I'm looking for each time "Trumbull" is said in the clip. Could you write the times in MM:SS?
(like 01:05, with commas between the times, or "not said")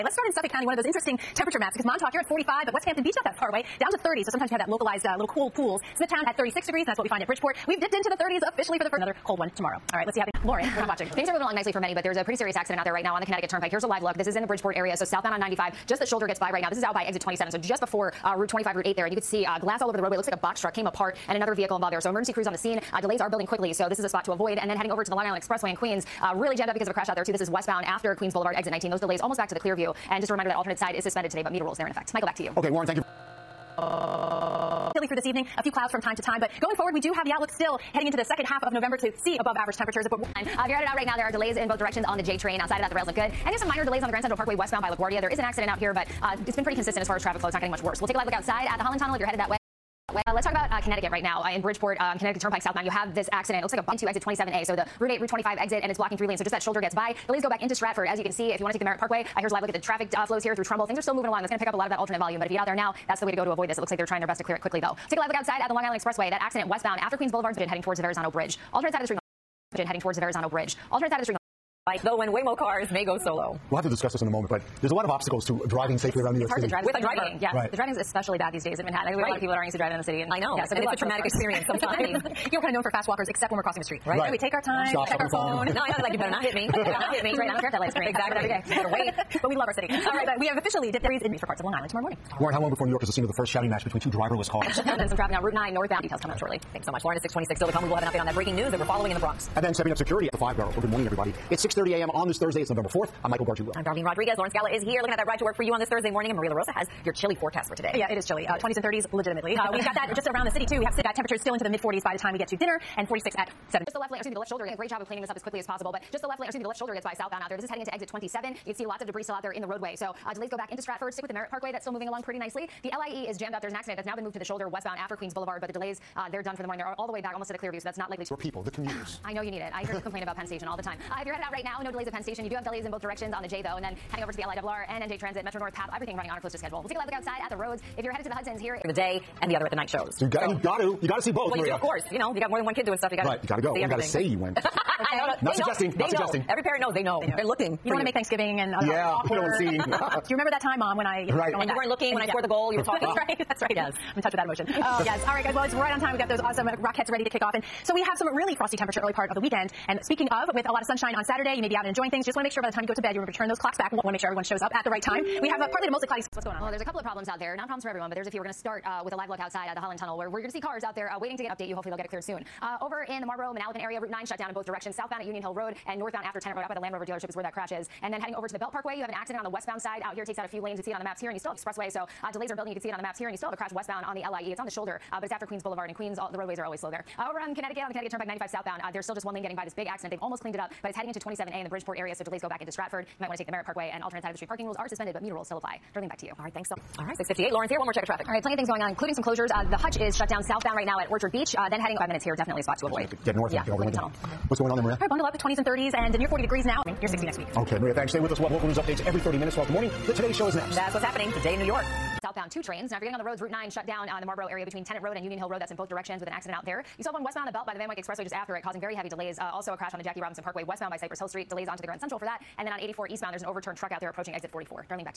01:00.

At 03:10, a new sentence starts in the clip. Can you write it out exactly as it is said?
They've almost cleaned it up, but it's heading into 27A in the Bridgeport area, so delays go back into Stratford.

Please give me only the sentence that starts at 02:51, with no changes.
You hopefully they'll get it cleared soon.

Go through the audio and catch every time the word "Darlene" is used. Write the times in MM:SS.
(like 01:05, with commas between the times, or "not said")
01:43, 03:15.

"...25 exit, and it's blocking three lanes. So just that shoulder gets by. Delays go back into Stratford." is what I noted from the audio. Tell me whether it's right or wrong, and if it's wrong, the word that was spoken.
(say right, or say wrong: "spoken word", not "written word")
right.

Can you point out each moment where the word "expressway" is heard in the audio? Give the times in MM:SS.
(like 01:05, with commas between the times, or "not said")
00:25, 01:05, 03:01, 03:37.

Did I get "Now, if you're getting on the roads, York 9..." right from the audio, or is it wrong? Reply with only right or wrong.
wrong.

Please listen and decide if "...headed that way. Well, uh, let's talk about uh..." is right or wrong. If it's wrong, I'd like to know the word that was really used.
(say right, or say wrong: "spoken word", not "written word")
right.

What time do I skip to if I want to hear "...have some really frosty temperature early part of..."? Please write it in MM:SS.
02:38.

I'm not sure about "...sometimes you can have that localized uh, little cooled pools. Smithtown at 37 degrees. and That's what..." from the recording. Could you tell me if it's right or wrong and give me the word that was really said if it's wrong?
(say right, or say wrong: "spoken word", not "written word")
wrong: "36", not "37".